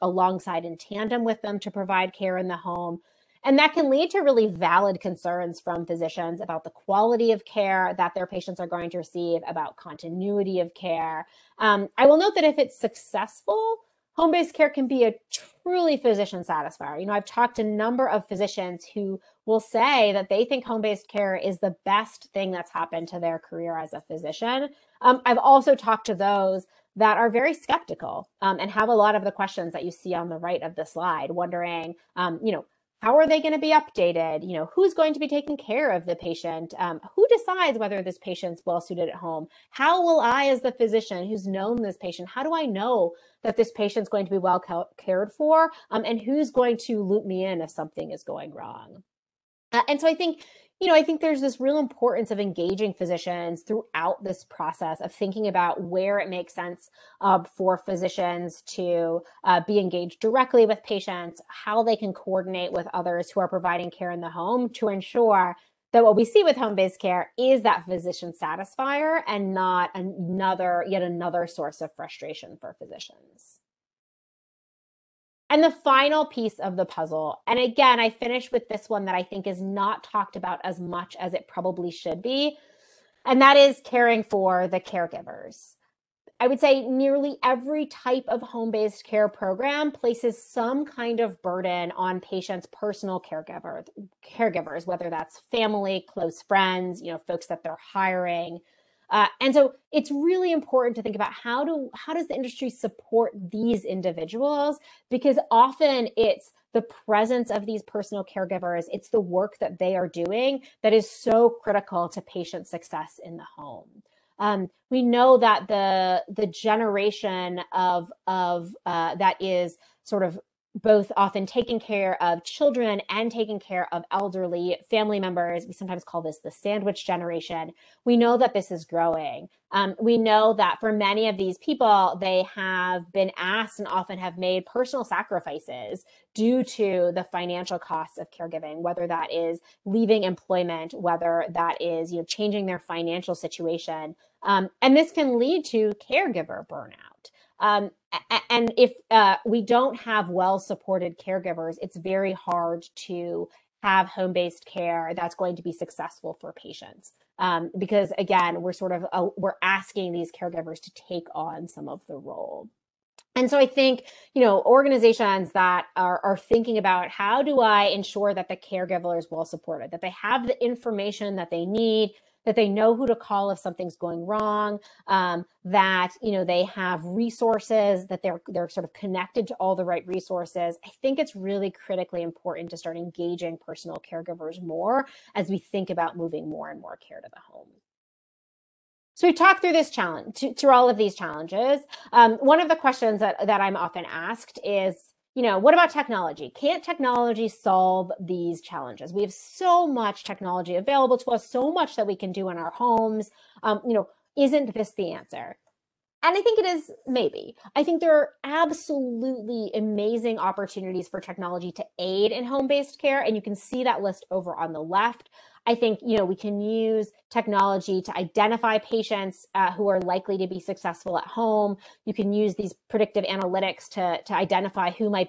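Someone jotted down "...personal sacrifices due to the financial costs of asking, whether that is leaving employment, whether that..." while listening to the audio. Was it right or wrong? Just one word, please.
wrong.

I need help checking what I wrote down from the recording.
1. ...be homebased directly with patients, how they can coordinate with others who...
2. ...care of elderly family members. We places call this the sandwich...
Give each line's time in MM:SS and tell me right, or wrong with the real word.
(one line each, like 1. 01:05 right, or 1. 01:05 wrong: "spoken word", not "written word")
1. 00:59 wrong: "engaged", not "homebased"
2. 02:03 wrong: "sometimes", not "places".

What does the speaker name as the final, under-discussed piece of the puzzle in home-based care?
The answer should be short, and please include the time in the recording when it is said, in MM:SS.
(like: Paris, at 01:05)
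caring for the caregivers, at 01:23.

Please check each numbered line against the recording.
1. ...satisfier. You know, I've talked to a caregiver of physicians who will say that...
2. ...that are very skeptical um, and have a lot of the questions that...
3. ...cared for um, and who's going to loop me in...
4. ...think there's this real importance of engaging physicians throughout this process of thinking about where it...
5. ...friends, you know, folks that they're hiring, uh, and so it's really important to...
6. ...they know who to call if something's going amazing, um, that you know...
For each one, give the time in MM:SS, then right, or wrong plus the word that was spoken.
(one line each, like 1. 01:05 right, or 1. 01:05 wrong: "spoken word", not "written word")
1. 00:16 wrong: "number", not "caregiver"
2. 00:26 right
3. 00:44 right
4. 00:51 right
5. 01:36 right
6. 02:52 wrong: "wrong", not "amazing".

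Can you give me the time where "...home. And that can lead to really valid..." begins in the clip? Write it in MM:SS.
00:02.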